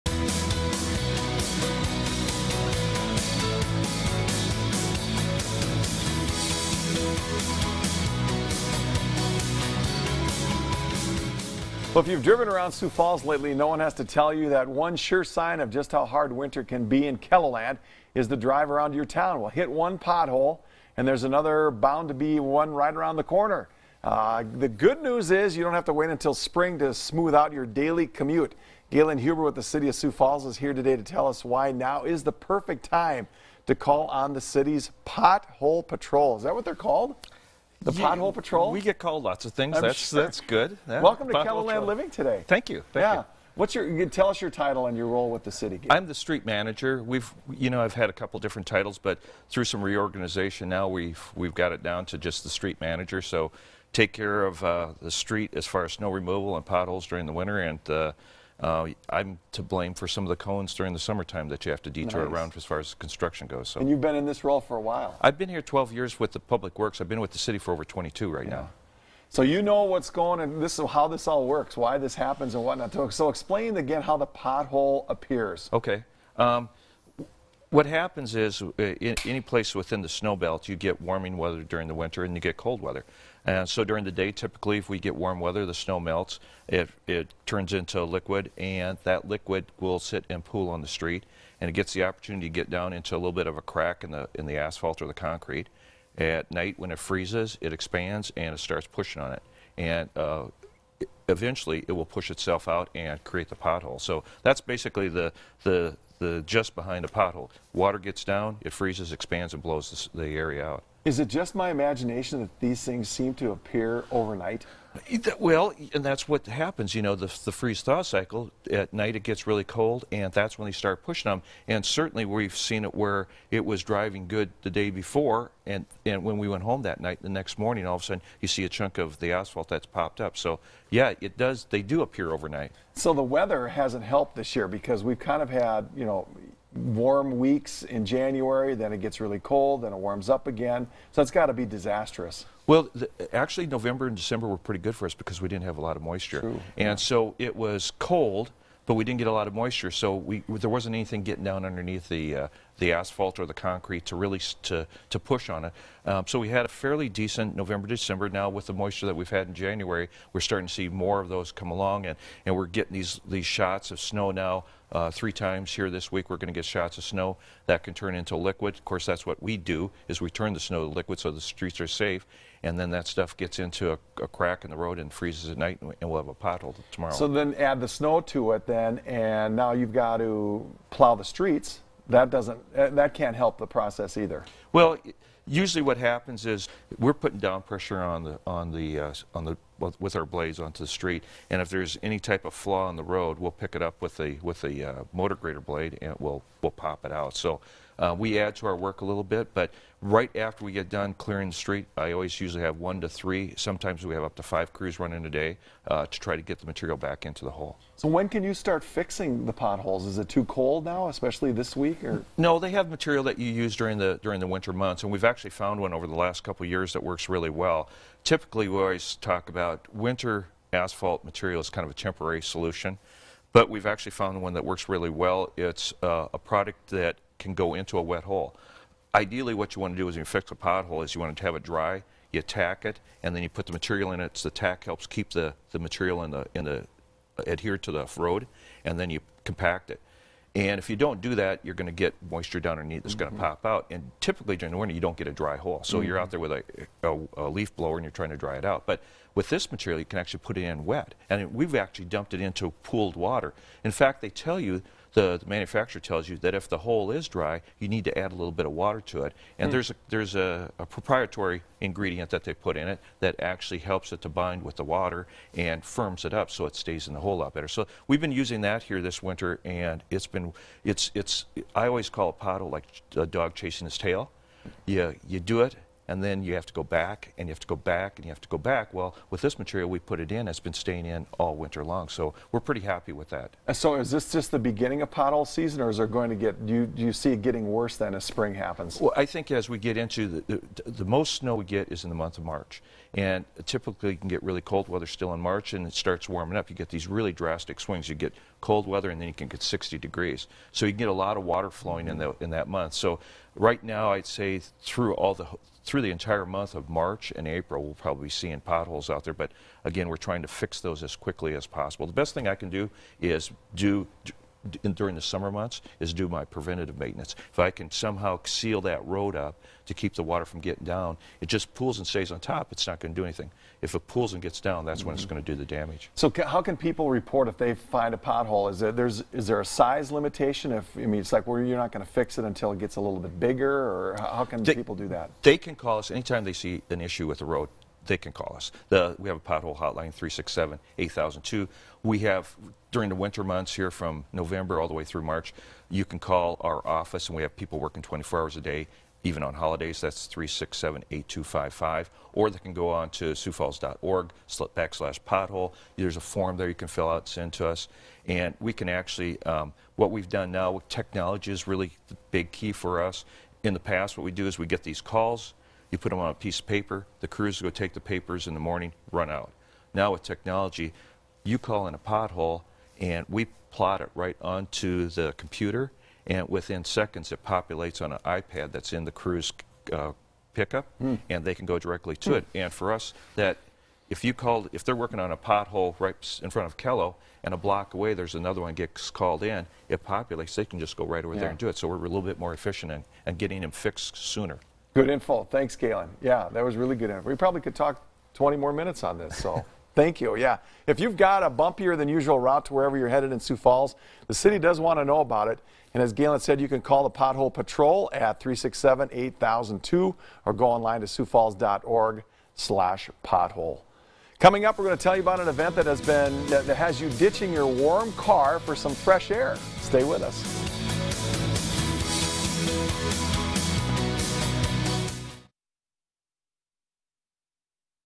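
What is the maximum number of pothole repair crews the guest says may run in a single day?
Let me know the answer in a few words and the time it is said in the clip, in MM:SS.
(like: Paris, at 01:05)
5, at 03:24.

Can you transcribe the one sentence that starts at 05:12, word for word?
The best thing I can do is do in, during the summer months is do my preventative maintenance.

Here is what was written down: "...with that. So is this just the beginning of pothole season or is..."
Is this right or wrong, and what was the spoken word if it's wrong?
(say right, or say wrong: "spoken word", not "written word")
right.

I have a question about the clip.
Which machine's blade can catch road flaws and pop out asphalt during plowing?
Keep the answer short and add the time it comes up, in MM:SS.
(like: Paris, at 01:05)
motor grader, at 03:15.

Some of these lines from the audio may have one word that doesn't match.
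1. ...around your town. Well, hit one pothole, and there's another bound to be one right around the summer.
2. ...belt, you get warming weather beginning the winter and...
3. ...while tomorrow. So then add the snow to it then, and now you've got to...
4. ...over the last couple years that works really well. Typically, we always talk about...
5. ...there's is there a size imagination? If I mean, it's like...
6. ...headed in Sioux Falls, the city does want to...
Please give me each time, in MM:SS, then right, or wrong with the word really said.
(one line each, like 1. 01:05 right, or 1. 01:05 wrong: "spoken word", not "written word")
1. 00:18 wrong: "corner", not "summer"
2. 01:20 wrong: "during", not "beginning"
3. 02:56 wrong: "pothole", not "while"
4. 03:35 right
5. 05:28 wrong: "limitation", not "imagination"
6. 06:43 right.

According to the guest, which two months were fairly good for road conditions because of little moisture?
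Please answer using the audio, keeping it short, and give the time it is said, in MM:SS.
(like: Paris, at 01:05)
November and December, at 02:37.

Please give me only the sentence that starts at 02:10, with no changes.
So, yeah, it does, they do appear overnight.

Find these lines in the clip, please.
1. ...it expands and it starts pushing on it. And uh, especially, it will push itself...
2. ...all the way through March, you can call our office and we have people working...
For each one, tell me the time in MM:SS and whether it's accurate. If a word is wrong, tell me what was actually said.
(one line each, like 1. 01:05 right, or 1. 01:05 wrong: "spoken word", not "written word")
1. 01:37 wrong: "eventually", not "especially"
2. 05:44 right.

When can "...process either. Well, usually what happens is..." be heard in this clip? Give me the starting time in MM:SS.
03:03.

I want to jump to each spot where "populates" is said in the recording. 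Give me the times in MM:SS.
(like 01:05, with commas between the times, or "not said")
06:17, 06:30.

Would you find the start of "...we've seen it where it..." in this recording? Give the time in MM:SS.
02:02.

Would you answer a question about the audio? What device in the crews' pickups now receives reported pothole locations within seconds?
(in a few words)
iPad.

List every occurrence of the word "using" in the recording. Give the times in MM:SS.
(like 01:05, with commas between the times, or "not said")
04:28.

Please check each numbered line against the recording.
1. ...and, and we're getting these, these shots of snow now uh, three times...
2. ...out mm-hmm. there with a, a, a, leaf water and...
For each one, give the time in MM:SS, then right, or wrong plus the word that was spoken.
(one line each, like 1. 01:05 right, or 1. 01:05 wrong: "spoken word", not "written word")
1. 02:42 right
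2. 04:06 wrong: "blower", not "water".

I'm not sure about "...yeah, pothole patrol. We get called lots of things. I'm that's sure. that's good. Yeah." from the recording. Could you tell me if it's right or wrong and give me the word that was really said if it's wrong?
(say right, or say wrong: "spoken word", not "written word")
right.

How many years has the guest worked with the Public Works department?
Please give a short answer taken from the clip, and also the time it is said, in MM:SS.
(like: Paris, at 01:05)
12, at 01:05.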